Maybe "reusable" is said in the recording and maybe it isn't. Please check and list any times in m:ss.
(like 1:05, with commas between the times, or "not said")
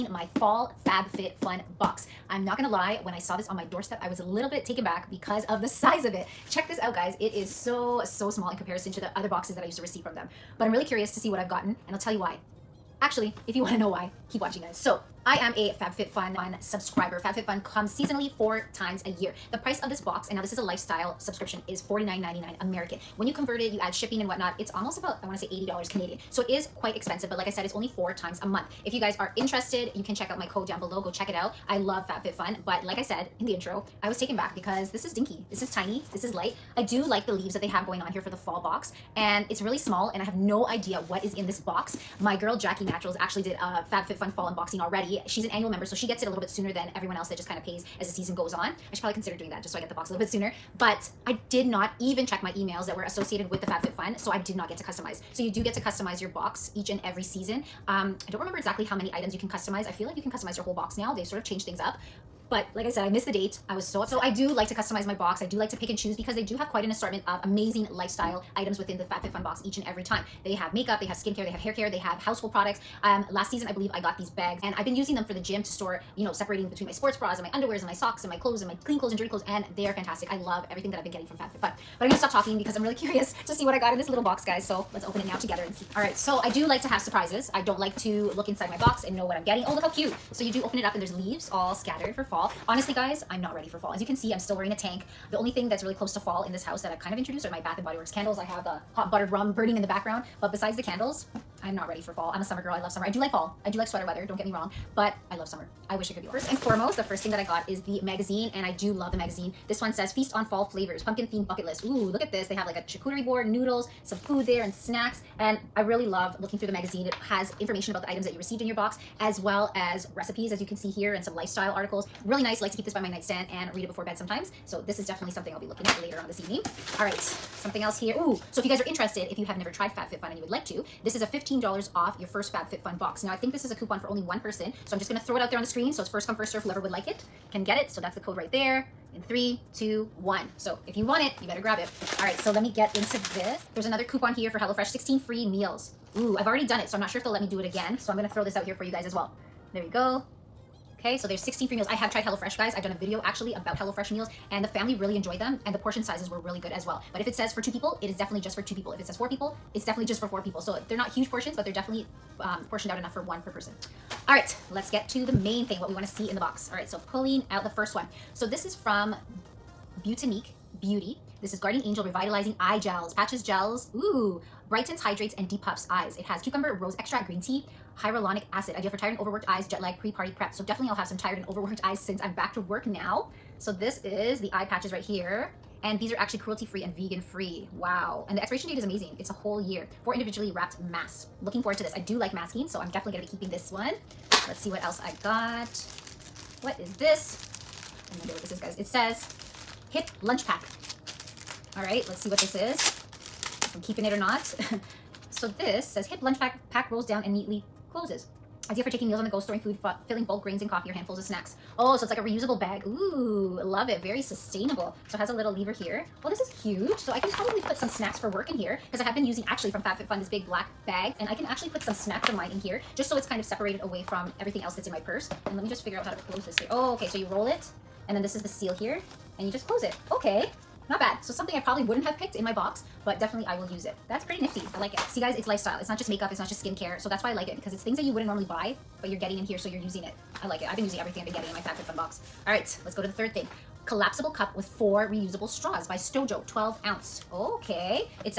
3:32, 4:05.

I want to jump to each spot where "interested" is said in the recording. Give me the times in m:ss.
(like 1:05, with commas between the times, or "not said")
0:29, 2:08.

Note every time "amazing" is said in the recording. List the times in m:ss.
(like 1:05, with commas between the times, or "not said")
1:07, 3:08.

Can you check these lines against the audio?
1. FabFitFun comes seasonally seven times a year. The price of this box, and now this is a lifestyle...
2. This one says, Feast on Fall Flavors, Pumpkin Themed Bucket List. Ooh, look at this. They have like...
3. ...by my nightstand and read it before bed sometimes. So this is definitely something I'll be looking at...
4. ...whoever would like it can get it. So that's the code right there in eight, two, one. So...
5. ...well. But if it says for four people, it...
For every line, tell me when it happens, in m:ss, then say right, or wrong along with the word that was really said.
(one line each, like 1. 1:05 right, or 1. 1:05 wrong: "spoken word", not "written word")
1. 0:17 wrong: "four", not "seven"
2. 1:49 right
3. 2:02 right
4. 2:16 wrong: "three", not "eight"
5. 2:36 wrong: "two", not "four".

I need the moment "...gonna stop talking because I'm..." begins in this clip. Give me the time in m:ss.
1:22.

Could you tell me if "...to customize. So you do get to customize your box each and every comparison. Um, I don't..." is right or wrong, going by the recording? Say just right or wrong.
wrong.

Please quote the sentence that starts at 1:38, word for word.
I have the hot buttered rum burning in the background.